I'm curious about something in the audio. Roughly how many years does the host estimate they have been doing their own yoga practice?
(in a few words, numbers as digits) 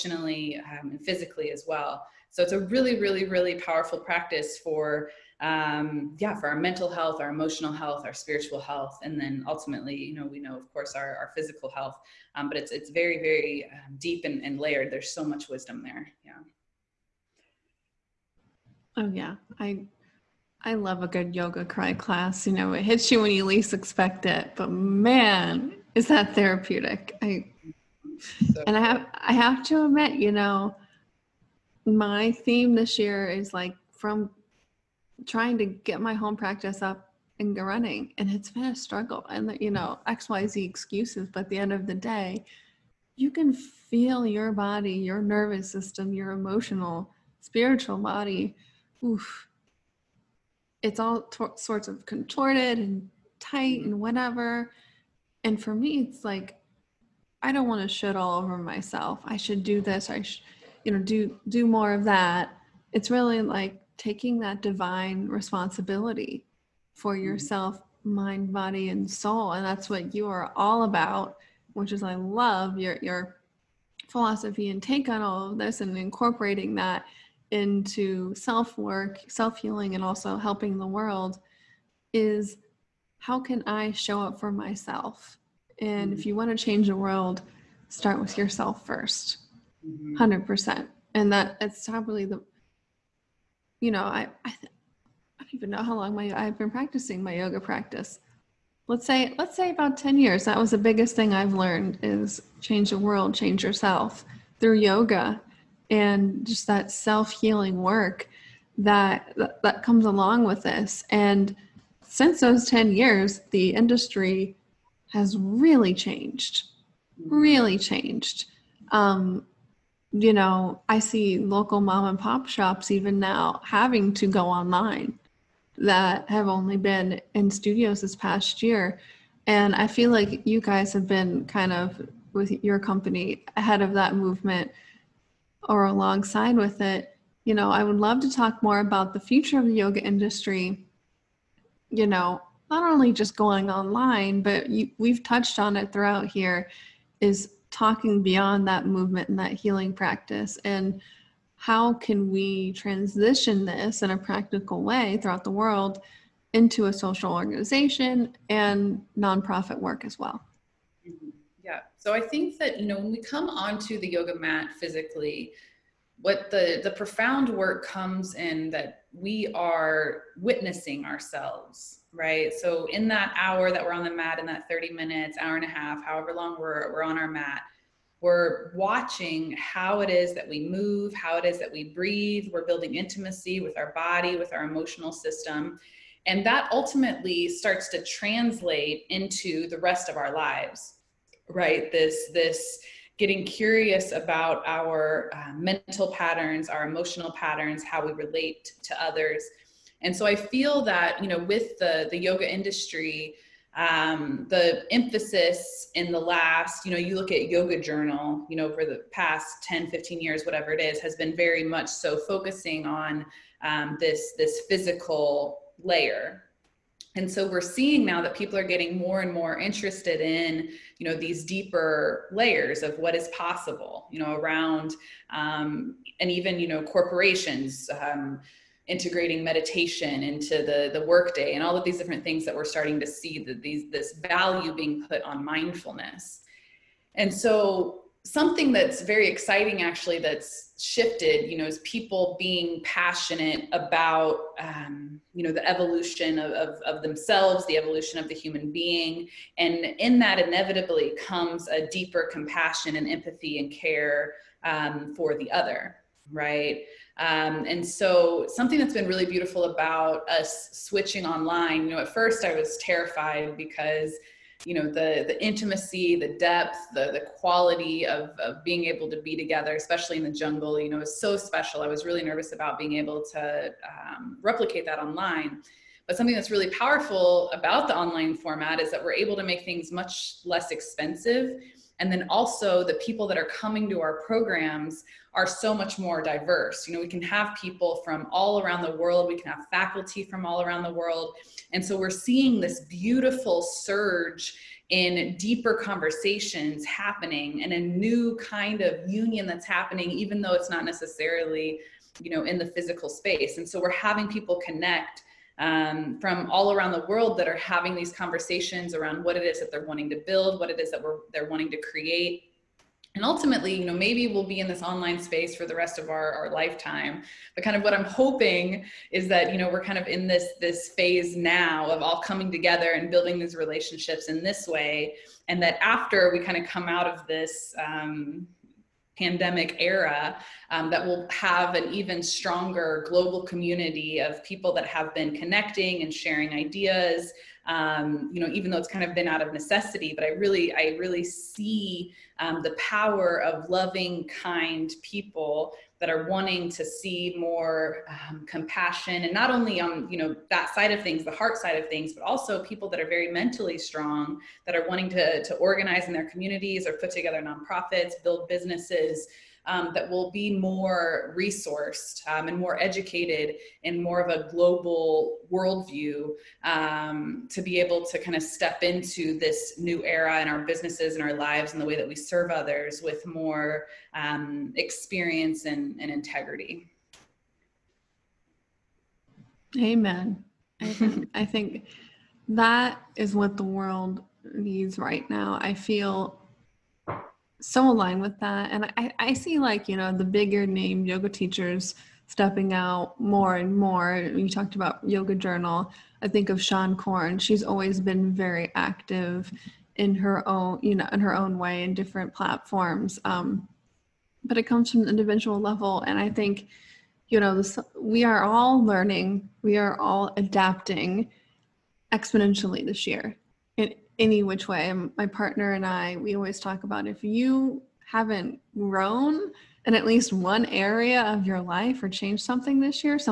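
10 years.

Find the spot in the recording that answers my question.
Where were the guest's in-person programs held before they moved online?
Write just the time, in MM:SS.
04:30.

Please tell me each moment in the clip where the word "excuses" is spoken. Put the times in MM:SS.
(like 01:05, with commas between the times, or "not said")
00:40.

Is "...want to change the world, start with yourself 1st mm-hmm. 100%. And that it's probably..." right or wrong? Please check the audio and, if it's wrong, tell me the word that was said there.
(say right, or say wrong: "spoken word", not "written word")
right.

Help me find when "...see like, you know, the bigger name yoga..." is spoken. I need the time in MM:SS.
06:29.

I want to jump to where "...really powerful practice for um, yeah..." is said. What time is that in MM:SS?
00:03.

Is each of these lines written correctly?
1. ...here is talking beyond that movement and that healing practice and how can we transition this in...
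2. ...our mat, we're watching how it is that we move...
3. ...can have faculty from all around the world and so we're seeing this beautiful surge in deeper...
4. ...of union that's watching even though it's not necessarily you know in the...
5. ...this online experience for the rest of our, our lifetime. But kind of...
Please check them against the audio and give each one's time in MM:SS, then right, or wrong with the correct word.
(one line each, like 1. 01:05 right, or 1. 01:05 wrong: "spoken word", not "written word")
1. 02:26 right
2. 02:57 right
3. 04:49 right
4. 04:58 wrong: "happening", not "watching"
5. 05:14 wrong: "space", not "experience".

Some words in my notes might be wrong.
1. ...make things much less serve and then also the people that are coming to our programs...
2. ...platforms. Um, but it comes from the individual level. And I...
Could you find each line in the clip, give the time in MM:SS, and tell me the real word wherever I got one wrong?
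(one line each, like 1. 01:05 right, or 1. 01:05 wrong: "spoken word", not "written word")
1. 04:39 wrong: "expensive", not "serve"
2. 06:42 right.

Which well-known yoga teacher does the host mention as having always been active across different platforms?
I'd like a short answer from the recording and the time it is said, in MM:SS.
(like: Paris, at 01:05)
Seane Corn, at 06:36.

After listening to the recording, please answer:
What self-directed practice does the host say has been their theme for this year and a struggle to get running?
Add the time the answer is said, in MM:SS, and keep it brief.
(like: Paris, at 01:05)
home practice, at 00:36.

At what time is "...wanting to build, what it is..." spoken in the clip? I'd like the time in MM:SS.
05:09.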